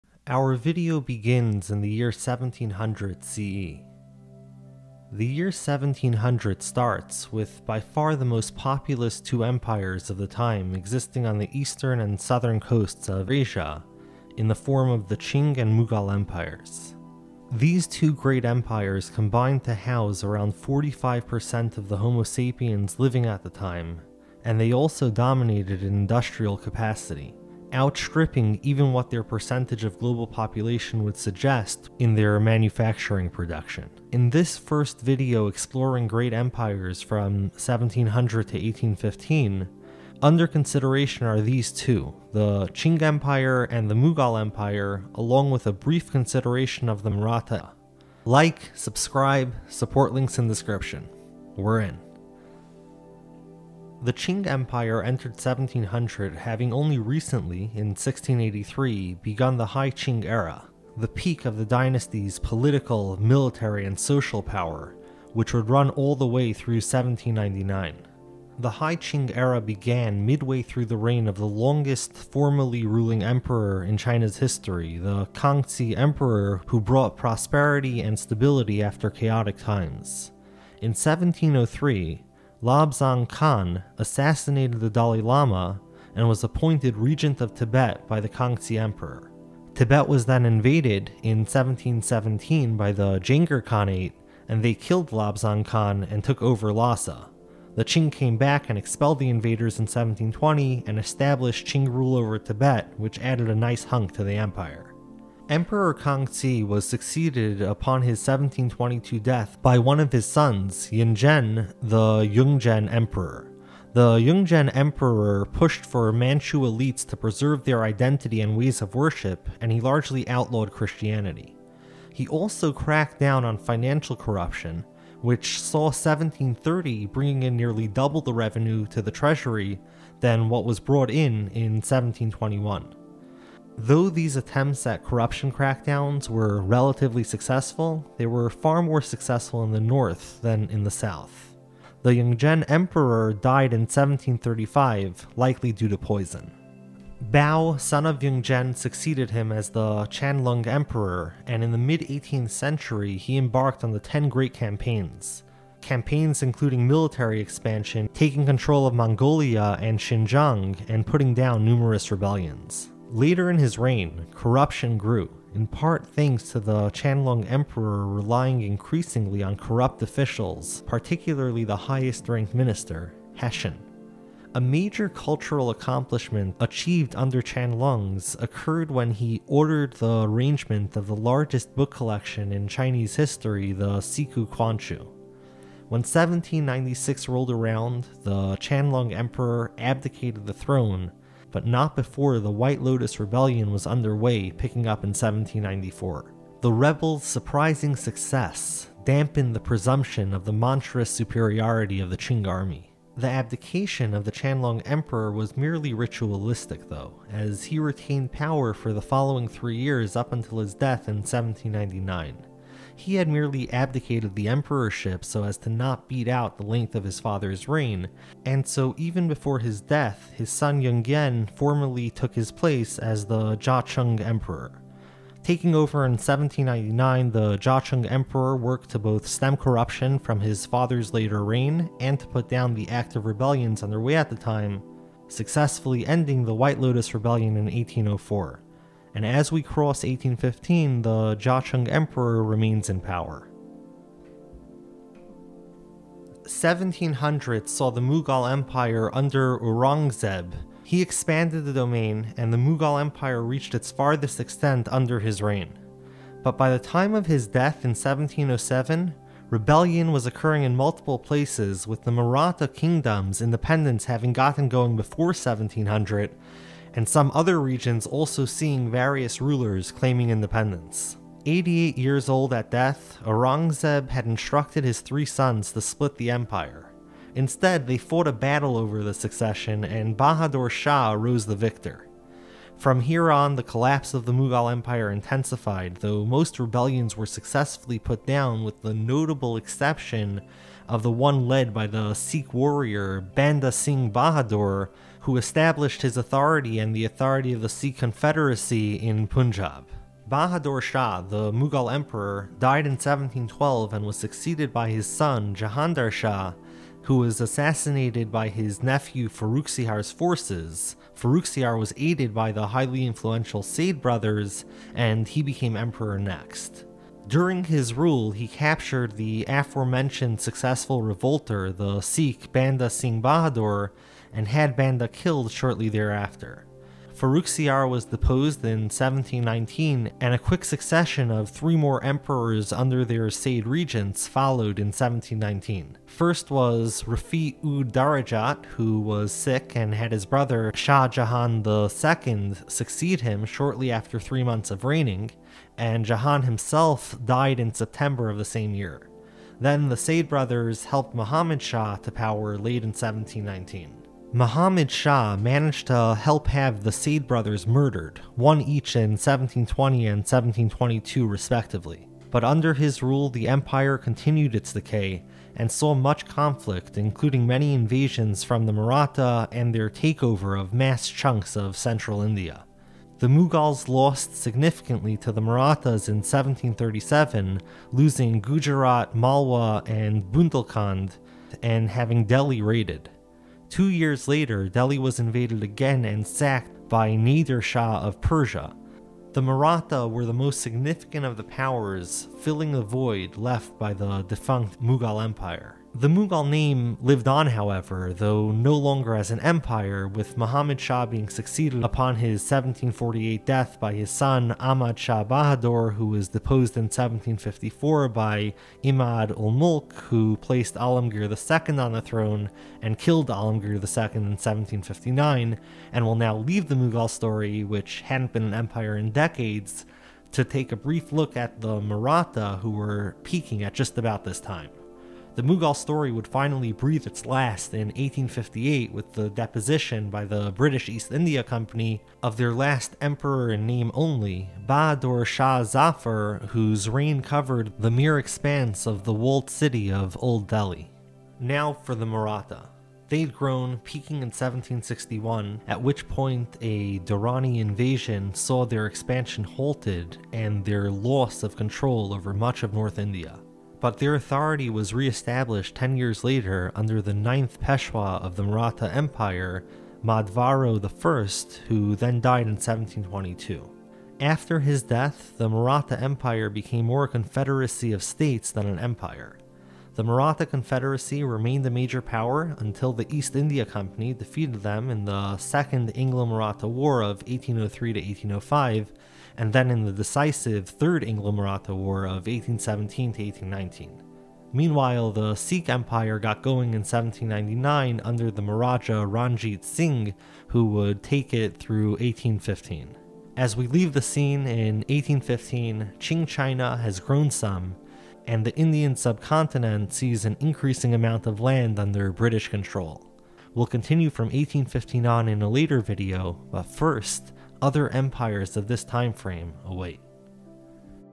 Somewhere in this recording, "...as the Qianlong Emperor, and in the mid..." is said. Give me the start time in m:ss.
2:29.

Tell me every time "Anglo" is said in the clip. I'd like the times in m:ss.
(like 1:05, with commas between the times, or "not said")
7:55, 8:01.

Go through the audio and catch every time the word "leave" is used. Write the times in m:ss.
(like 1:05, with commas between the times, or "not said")
6:56, 8:13.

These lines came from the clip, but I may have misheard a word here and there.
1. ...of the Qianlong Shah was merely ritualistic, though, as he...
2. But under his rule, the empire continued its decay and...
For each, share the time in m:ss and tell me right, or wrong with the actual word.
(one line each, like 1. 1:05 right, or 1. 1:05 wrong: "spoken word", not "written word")
1. 3:24 wrong: "Emperor", not "Shah"
2. 6:02 right.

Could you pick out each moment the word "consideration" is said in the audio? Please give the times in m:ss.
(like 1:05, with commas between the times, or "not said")
0:40, 0:46.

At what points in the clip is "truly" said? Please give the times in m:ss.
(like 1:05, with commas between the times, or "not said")
not said.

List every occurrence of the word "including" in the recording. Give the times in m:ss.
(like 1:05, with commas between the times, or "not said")
2:36, 6:06.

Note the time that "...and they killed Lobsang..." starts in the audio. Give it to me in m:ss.
1:34.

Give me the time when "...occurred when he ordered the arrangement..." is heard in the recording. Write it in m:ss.
2:58.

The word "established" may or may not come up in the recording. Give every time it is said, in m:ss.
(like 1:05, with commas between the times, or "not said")
1:40, 4:55, 7:34.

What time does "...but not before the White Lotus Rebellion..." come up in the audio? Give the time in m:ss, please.
3:11.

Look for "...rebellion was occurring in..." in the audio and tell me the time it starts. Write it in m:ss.
4:19.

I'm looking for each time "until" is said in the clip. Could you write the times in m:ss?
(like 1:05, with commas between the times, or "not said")
3:30, 7:52.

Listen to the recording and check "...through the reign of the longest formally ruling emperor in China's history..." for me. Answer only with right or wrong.
right.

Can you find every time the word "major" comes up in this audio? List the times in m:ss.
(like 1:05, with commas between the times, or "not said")
2:54, 7:51.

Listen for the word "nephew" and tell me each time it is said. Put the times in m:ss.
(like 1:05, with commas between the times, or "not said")
5:08.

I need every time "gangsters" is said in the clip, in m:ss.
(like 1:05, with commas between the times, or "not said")
not said.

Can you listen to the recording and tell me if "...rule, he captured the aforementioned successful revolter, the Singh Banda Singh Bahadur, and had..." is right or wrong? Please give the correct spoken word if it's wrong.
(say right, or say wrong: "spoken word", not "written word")
wrong: "Sikh", not "Singh".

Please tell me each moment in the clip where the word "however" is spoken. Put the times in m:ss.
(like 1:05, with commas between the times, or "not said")
6:37.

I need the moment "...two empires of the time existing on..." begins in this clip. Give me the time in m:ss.
0:09.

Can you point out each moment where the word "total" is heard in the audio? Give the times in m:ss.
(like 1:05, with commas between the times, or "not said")
not said.